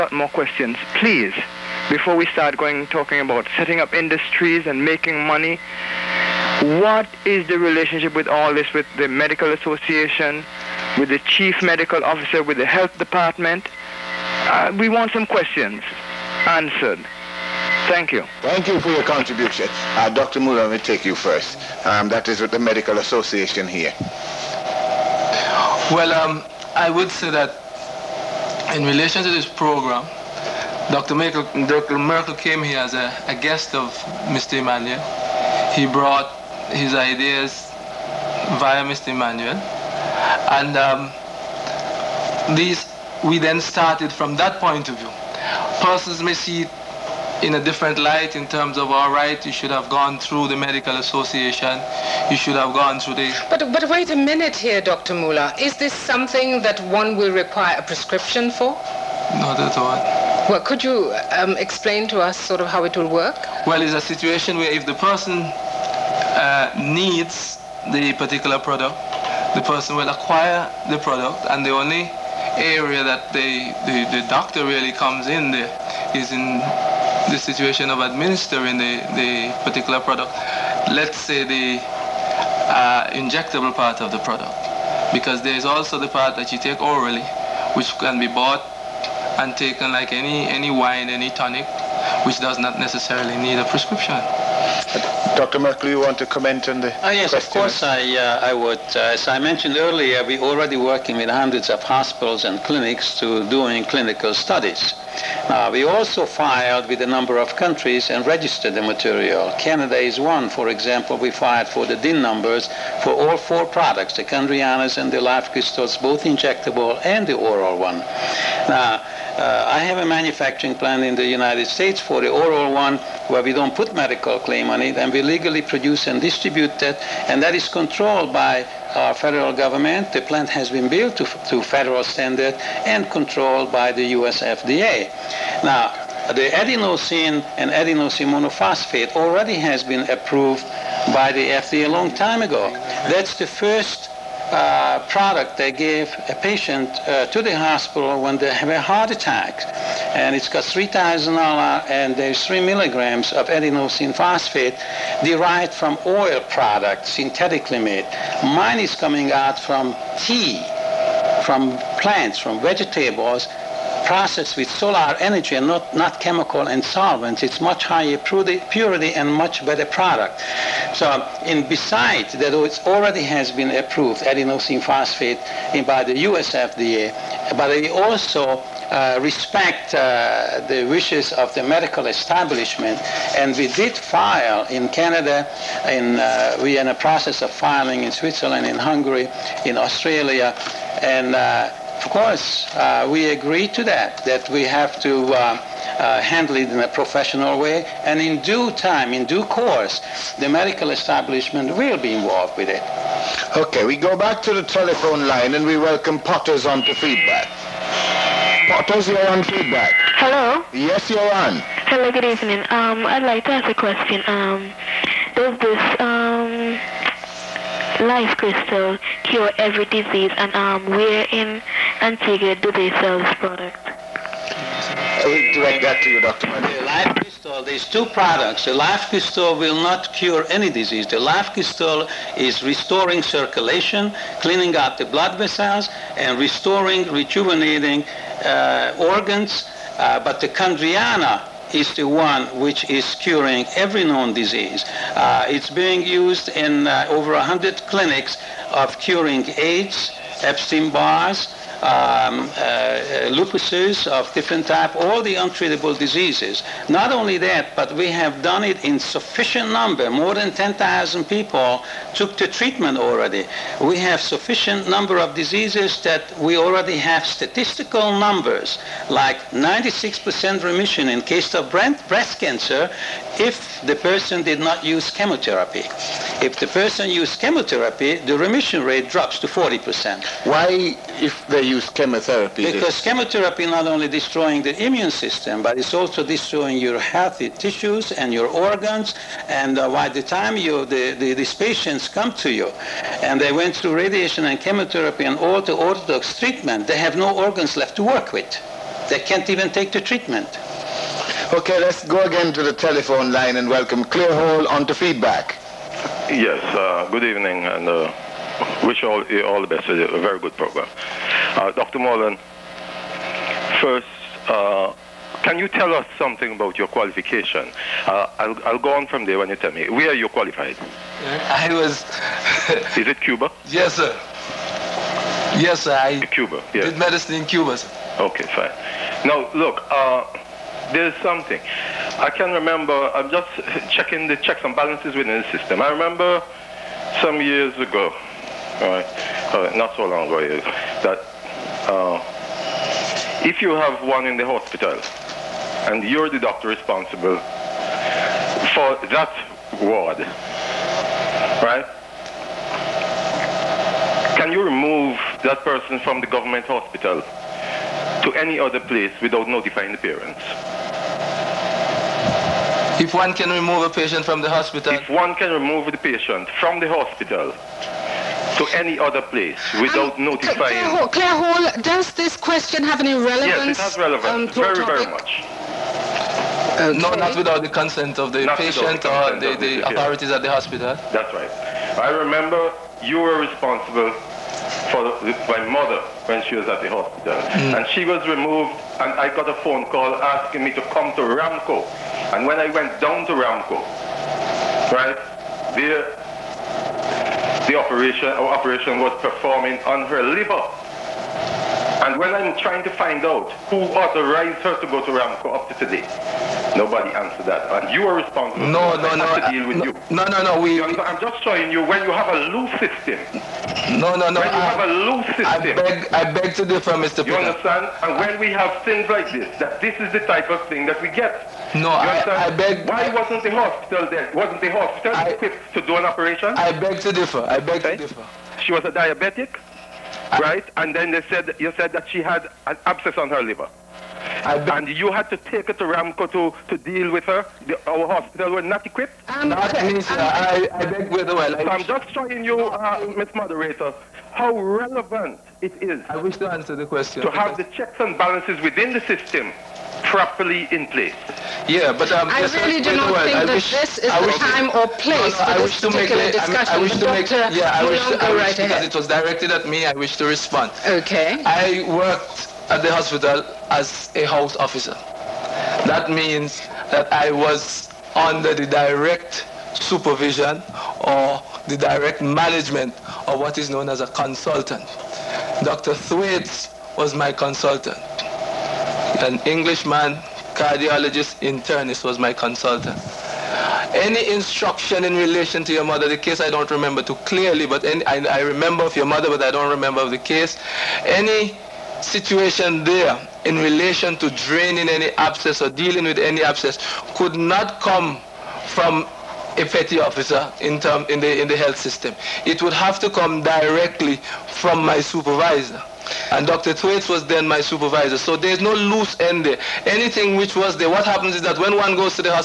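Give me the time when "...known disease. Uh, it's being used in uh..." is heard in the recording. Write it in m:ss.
4:04.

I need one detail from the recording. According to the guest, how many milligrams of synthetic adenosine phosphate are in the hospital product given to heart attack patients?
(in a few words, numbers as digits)
3.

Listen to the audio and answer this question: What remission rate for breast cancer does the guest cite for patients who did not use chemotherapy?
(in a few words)
96%.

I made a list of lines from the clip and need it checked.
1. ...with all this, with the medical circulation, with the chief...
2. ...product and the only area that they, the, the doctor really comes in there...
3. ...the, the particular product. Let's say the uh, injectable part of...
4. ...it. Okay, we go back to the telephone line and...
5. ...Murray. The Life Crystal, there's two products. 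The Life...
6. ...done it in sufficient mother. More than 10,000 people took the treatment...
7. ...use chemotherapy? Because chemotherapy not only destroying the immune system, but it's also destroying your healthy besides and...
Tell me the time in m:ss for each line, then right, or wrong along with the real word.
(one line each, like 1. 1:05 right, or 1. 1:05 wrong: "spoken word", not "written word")
1. 0:08 wrong: "association", not "circulation"
2. 1:10 right
3. 1:18 right
4. 3:22 right
5. 3:46 right
6. 4:18 wrong: "number", not "mother"
7. 4:41 wrong: "tissues", not "besides".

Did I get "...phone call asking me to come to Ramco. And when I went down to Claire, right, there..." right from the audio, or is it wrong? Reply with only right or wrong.
wrong.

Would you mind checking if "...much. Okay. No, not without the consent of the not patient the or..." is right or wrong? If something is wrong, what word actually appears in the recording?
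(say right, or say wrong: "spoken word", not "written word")
right.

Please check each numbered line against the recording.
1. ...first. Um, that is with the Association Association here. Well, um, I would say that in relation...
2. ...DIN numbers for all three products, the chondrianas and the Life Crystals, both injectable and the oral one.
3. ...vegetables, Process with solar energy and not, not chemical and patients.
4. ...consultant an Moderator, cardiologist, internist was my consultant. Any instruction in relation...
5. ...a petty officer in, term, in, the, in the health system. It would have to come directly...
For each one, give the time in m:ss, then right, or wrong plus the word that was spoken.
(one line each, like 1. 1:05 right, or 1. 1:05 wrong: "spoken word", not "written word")
1. 0:21 wrong: "Medical", not "Association"
2. 1:51 wrong: "four", not "three"
3. 2:42 wrong: "solvents", not "patients"
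4. 7:57 wrong: "Englishman", not "Moderator"
5. 8:19 right.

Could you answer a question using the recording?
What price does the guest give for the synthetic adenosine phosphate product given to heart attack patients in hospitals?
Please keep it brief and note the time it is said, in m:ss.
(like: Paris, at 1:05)
$3,000, at 2:30.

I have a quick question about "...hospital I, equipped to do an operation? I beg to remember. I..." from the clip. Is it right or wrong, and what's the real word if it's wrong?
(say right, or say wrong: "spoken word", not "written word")
wrong: "differ", not "remember".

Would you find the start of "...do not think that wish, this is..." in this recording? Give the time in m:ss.
7:32.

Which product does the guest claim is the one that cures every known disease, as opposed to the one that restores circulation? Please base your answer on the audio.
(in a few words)
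Chondriana.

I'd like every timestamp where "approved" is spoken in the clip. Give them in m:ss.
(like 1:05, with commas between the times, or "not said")
2:20, 2:53.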